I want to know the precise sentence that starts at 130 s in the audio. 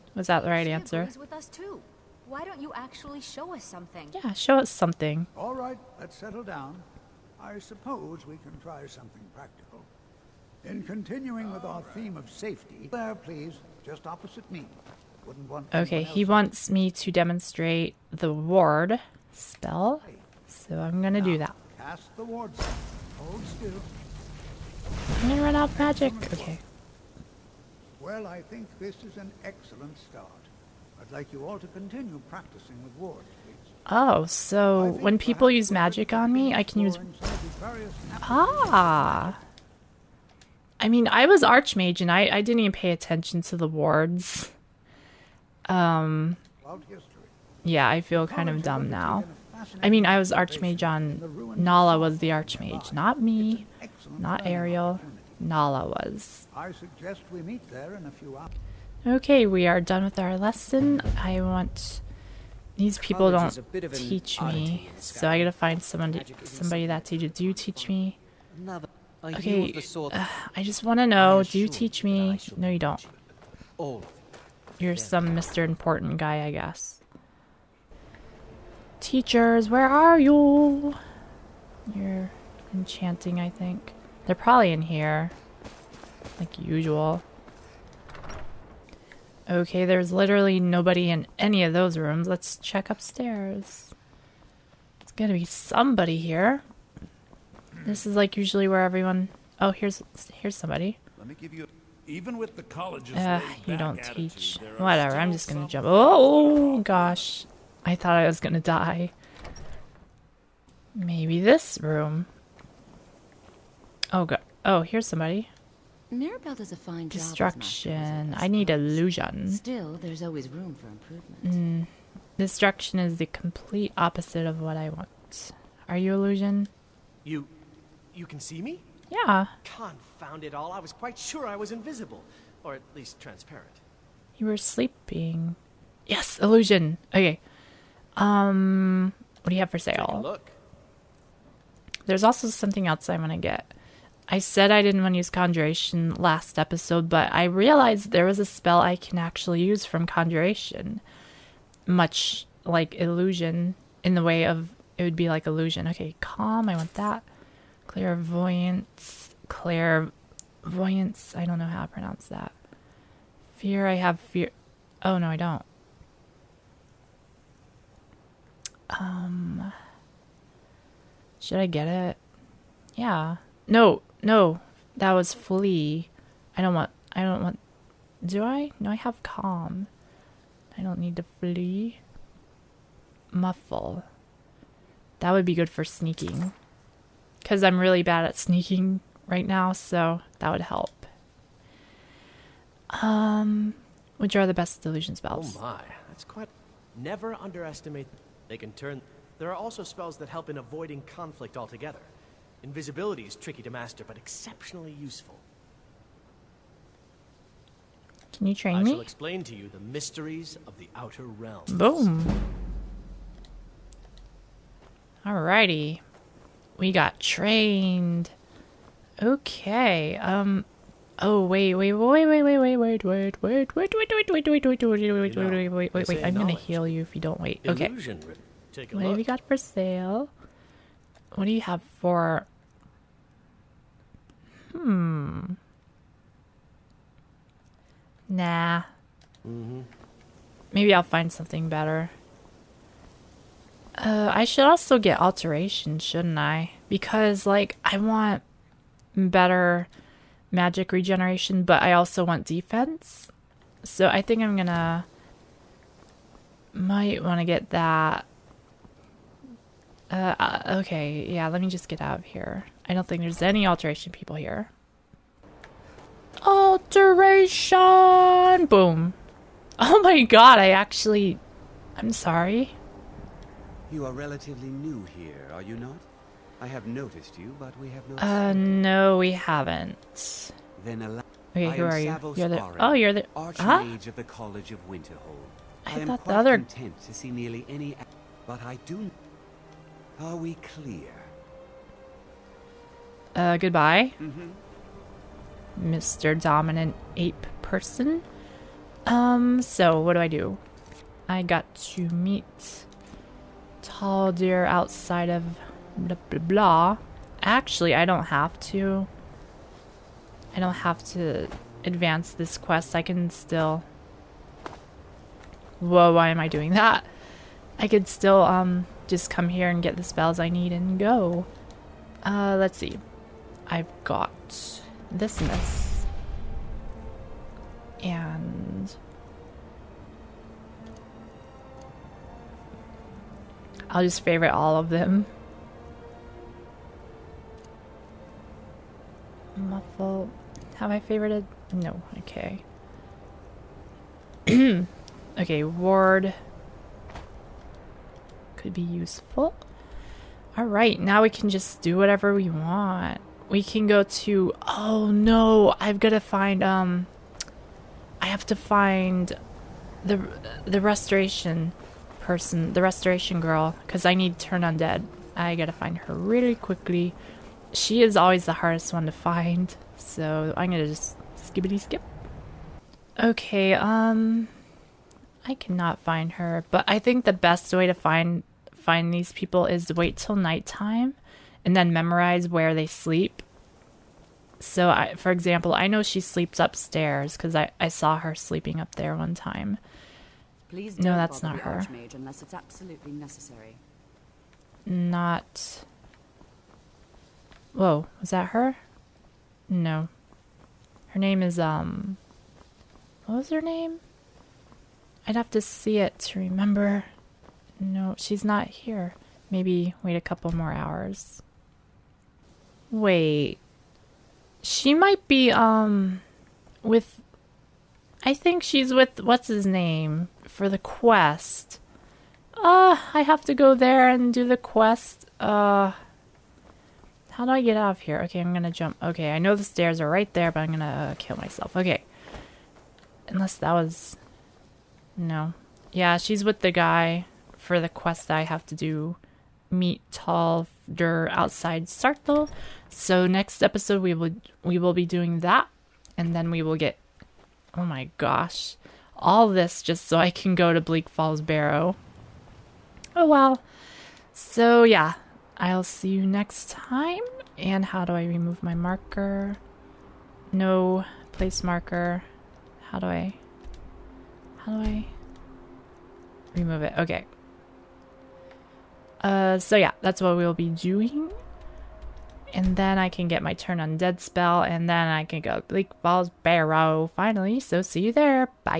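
I was quite sure I was invisible, or at least transparent.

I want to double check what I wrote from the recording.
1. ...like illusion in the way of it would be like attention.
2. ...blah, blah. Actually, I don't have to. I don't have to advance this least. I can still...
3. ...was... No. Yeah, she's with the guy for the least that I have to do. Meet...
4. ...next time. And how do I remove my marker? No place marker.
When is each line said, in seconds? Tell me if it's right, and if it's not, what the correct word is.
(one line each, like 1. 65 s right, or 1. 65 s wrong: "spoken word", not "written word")
1. 152 s wrong: "illusion", not "attention"
2. 306 s wrong: "quest", not "least"
3. 433 s wrong: "quest", not "least"
4. 456 s right.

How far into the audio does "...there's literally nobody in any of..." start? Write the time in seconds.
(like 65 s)
89 s.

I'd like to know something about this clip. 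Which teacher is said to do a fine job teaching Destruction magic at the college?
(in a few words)
Mirabelle.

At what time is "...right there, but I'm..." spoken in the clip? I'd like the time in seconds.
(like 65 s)
430 s.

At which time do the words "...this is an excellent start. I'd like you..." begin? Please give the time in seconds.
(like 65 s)
28 s.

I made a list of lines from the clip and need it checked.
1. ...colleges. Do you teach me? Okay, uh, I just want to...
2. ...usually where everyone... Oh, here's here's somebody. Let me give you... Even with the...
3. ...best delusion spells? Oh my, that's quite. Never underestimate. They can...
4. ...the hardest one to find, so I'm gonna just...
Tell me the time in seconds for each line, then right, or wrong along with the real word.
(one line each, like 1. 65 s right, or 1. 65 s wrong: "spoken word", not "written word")
1. 67 s wrong: "teaches", not "colleges"
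2. 98 s right
3. 194 s right
4. 368 s right.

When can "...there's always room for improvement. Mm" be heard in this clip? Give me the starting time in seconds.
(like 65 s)
120 s.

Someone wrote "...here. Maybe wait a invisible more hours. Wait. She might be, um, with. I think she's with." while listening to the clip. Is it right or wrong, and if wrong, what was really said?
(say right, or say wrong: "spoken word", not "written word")
wrong: "couple", not "invisible".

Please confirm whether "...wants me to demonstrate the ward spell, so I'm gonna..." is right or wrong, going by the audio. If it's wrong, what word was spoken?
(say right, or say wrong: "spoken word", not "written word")
right.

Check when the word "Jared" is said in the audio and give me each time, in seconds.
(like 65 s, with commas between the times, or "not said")
not said.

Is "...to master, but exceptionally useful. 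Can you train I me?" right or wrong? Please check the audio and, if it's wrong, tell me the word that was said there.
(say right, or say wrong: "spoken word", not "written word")
right.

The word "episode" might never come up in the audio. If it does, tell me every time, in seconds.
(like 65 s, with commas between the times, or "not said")
146 s, 443 s.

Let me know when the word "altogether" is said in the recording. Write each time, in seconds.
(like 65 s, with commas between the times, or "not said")
201 s.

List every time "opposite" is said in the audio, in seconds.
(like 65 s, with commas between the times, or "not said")
14 s, 123 s.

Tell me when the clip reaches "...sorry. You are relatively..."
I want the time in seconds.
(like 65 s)
272 s.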